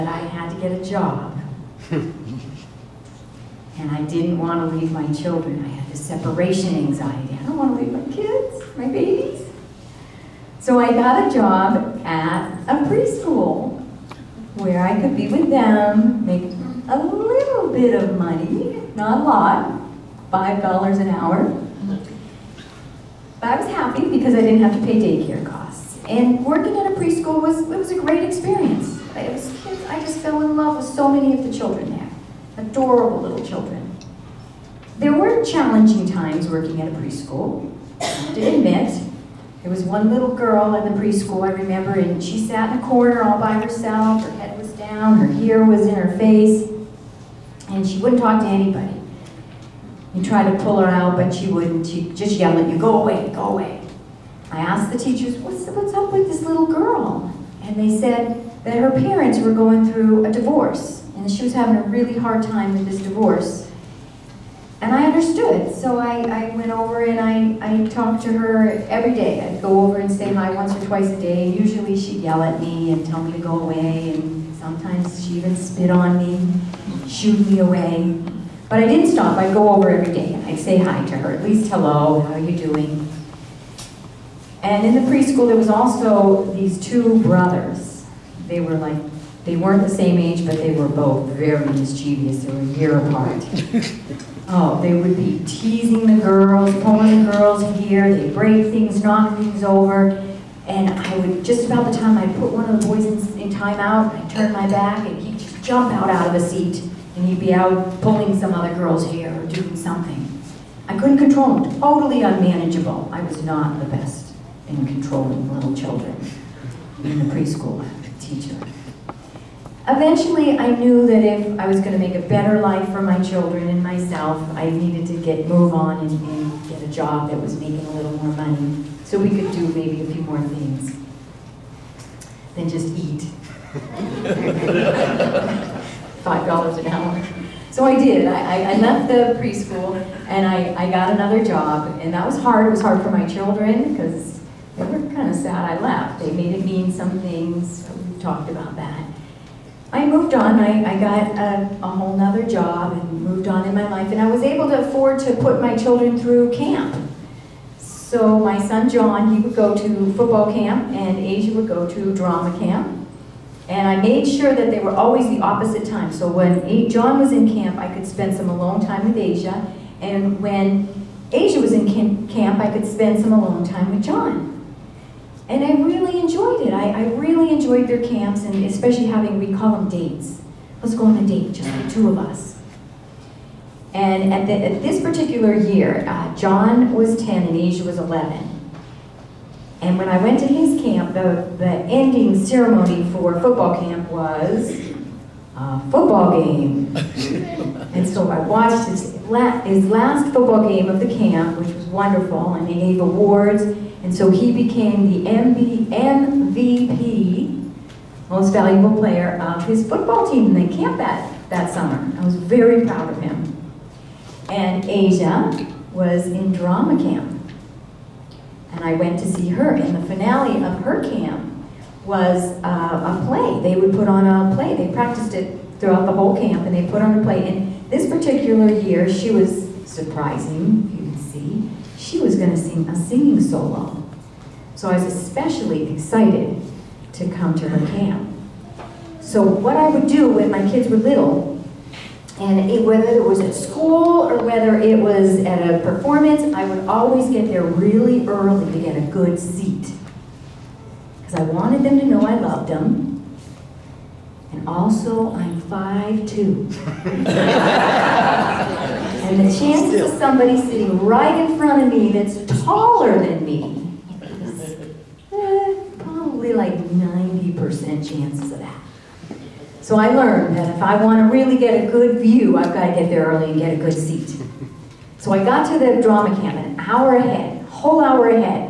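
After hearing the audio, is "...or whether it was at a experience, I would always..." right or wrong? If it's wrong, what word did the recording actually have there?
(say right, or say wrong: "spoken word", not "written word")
wrong: "performance", not "experience".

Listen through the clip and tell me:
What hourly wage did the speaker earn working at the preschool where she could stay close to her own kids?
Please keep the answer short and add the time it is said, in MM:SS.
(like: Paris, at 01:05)
$5 an hour, at 00:20.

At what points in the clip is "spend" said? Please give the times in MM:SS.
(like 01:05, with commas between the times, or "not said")
02:48, 02:52.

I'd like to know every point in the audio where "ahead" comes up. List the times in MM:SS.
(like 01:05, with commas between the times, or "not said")
04:37.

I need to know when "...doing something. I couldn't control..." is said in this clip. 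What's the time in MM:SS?
01:49.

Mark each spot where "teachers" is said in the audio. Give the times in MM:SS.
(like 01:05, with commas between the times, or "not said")
00:54, 01:58.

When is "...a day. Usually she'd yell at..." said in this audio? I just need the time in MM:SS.
01:11.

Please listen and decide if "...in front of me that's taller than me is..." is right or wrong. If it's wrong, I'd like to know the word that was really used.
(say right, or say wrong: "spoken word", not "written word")
right.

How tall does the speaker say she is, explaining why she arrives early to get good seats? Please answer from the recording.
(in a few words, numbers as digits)
5'2".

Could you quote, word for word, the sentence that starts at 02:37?
So my son John, he would go to football camp, and Asia would go to drama camp.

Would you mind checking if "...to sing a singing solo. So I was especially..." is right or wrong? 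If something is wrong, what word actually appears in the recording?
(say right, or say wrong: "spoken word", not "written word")
right.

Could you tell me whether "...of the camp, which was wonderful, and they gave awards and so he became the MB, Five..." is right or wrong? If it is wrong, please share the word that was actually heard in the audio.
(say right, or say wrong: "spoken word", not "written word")
wrong: "MVP", not "Five".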